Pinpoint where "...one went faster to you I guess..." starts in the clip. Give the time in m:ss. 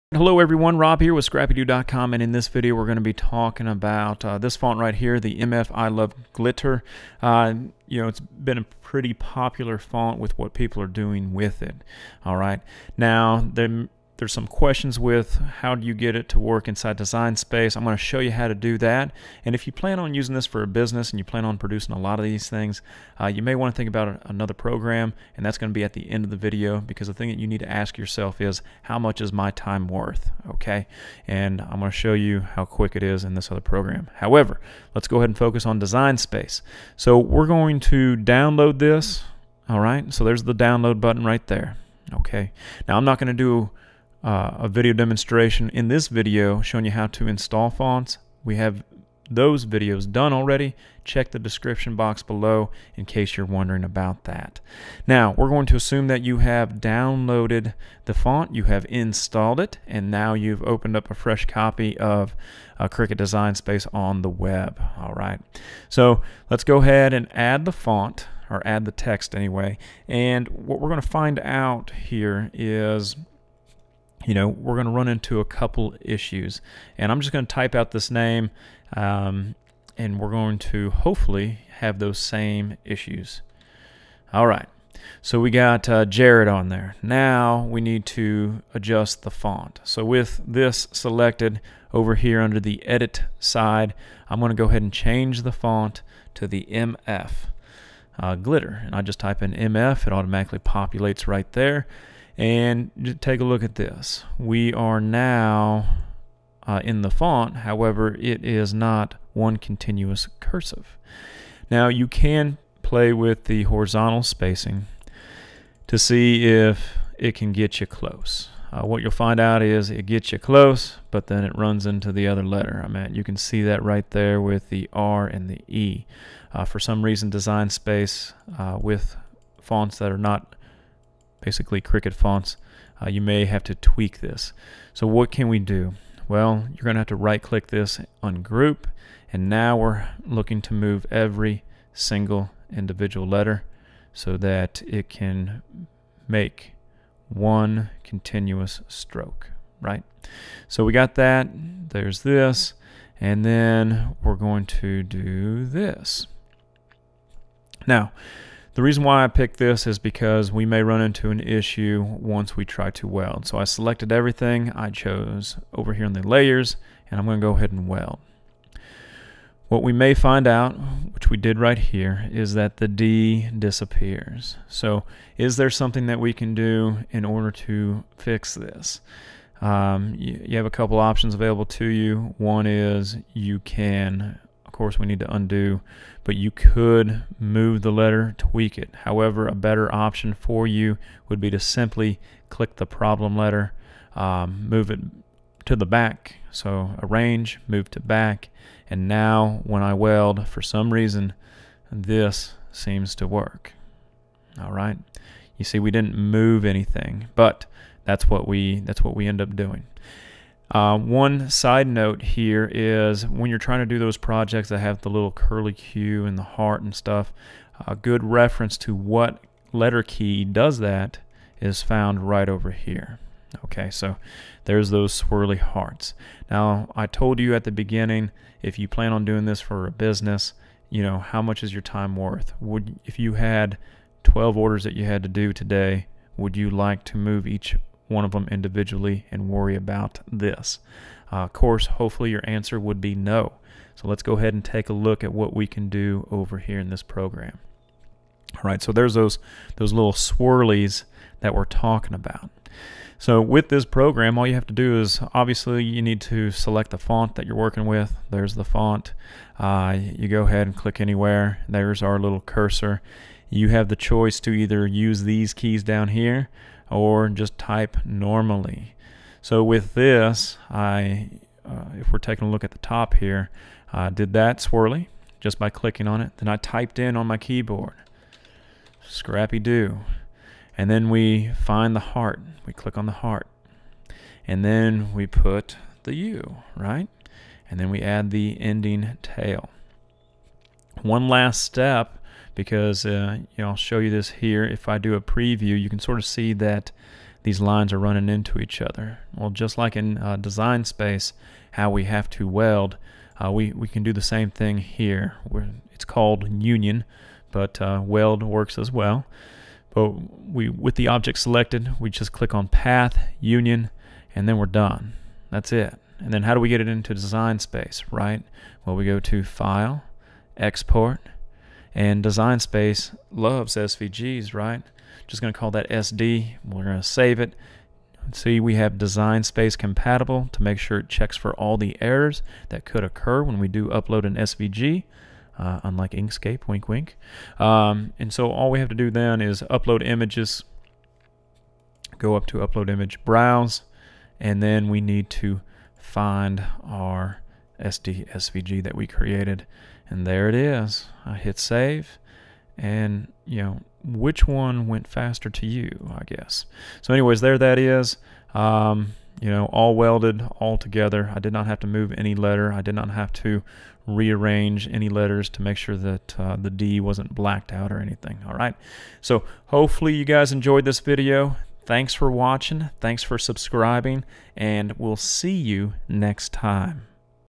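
5:54.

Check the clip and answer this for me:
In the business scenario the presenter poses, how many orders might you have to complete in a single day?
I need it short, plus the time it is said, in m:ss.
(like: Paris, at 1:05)
12, at 3:54.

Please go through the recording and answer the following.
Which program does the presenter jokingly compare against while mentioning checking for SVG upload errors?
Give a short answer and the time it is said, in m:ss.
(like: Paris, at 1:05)
Inkscape, at 5:36.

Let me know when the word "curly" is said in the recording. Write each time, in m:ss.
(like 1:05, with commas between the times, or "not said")
3:35.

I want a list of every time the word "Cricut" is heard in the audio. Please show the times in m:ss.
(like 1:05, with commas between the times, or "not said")
1:02, 2:11.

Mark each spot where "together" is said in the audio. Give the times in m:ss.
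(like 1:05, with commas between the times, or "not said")
6:00.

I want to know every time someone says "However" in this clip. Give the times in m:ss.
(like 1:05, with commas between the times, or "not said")
0:34, 1:47, 3:09.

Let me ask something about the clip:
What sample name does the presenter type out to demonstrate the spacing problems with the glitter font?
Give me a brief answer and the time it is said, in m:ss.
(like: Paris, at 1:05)
Jared, at 1:26.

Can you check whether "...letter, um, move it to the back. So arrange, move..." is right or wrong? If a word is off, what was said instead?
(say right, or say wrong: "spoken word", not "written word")
right.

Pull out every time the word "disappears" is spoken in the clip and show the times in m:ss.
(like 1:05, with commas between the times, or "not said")
2:53.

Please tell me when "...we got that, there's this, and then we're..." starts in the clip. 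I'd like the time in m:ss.
2:30.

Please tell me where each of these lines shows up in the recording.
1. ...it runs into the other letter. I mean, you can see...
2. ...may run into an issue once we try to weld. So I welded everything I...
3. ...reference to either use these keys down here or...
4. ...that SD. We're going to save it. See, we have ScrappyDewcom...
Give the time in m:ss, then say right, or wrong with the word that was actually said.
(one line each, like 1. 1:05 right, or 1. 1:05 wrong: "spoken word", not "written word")
1. 2:01 right
2. 2:40 wrong: "selected", not "welded"
3. 4:23 wrong: "choice", not "reference"
4. 5:25 wrong: "Design", not "ScrappyDewcom".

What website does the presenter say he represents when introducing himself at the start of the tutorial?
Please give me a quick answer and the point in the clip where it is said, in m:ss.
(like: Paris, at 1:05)
ScrappyDew.com, at 0:01.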